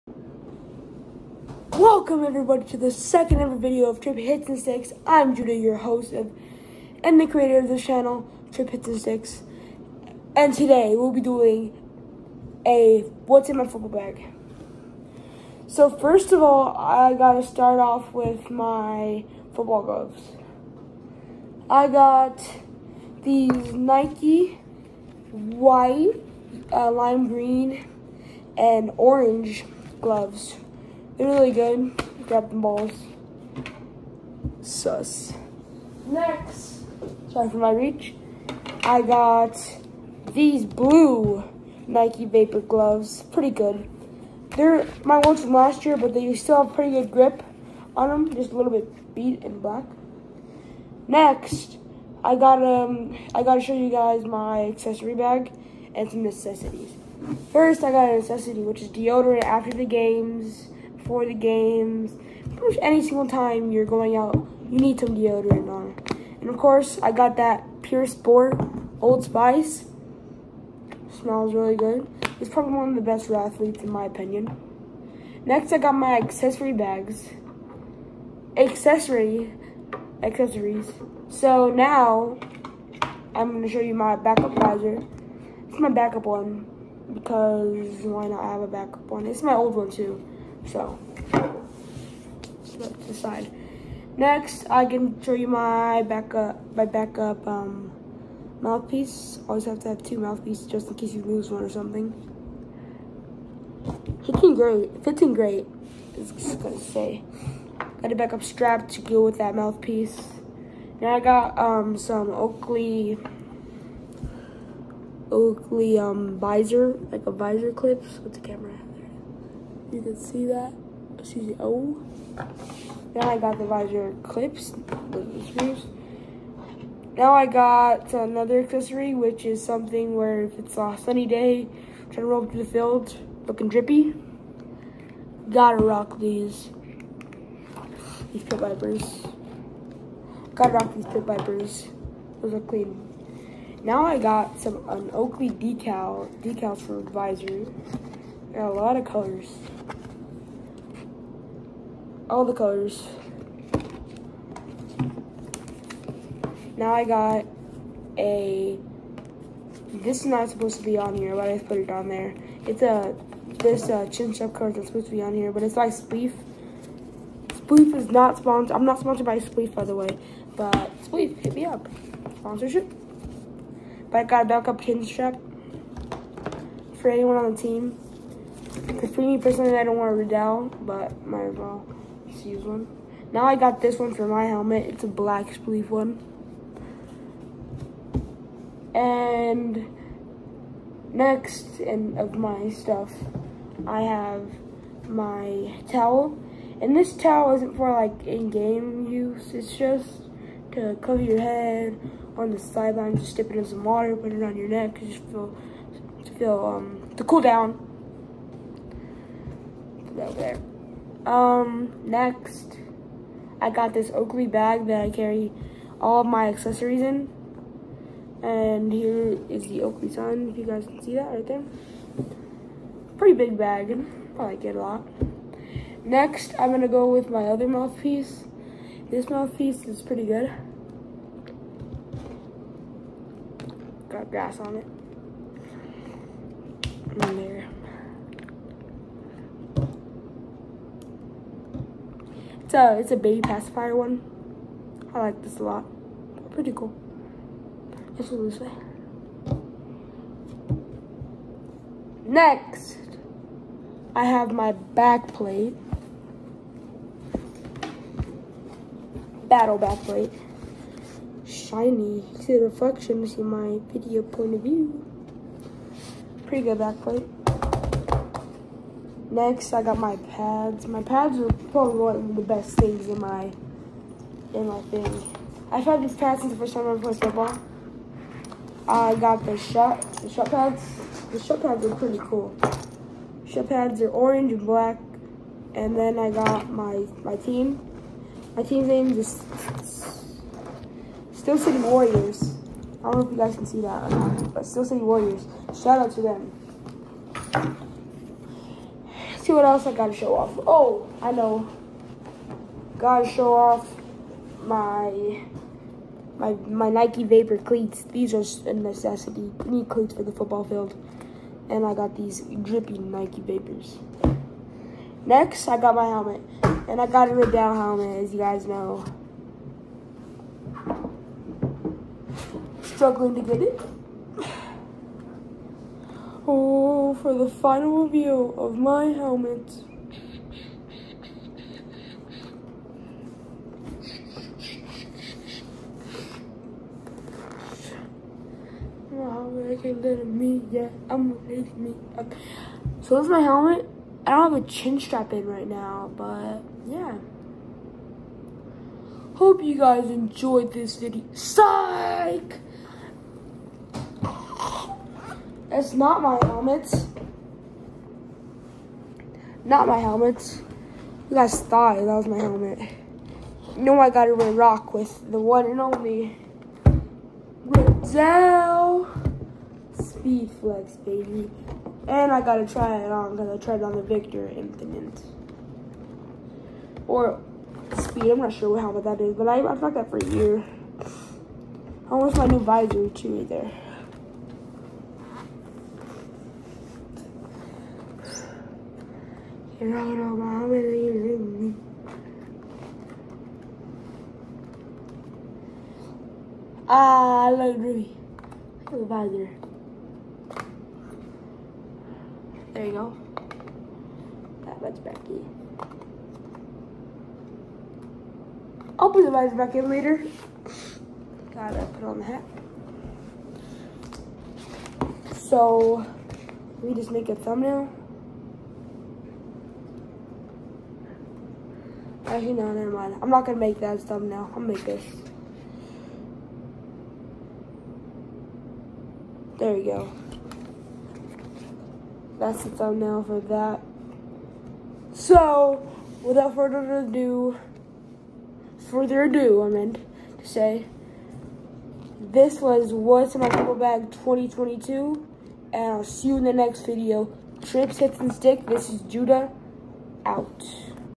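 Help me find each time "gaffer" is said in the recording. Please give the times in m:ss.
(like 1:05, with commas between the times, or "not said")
not said.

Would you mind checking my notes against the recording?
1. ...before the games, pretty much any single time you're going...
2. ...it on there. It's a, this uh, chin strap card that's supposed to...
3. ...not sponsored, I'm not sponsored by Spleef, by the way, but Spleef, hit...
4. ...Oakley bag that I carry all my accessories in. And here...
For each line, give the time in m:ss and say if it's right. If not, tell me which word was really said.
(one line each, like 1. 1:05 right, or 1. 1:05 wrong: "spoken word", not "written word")
1. 1:01 right
2. 2:41 right
3. 2:48 right
4. 3:34 right.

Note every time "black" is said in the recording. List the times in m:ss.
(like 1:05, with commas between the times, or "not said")
0:49, 3:05, 4:44.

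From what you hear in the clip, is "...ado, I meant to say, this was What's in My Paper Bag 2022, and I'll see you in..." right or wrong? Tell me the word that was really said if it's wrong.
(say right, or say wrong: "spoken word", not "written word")
right.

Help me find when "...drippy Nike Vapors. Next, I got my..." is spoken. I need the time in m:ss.
5:12.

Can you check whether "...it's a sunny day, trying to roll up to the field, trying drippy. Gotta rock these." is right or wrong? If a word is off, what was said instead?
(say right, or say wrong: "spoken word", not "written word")
wrong: "looking", not "trying".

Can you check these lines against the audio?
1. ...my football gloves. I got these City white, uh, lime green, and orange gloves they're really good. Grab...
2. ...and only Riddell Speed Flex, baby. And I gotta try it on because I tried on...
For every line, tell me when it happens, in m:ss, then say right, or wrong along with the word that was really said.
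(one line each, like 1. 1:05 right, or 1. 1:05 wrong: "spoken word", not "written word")
1. 0:18 wrong: "Nike", not "City"
2. 6:05 right.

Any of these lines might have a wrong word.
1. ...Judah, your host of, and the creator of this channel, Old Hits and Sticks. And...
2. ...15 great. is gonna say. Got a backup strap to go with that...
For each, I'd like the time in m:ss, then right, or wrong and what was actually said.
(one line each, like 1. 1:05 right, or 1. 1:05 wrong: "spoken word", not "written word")
1. 0:05 wrong: "Tripp", not "Old"
2. 1:45 right.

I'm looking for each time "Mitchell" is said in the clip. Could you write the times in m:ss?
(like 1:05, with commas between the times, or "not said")
not said.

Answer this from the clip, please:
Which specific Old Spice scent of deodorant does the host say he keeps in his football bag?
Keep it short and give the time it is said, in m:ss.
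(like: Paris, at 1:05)
Pure Sport, at 1:07.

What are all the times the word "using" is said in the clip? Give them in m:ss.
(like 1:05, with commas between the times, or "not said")
6:30.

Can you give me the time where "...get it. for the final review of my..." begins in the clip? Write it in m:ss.
5:23.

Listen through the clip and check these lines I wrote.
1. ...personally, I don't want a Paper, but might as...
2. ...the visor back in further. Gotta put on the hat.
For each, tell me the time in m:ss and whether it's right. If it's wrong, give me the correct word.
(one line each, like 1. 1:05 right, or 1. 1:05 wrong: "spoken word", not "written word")
1. 2:59 wrong: "Riddell", not "Paper"
2. 6:49 wrong: "later", not "further".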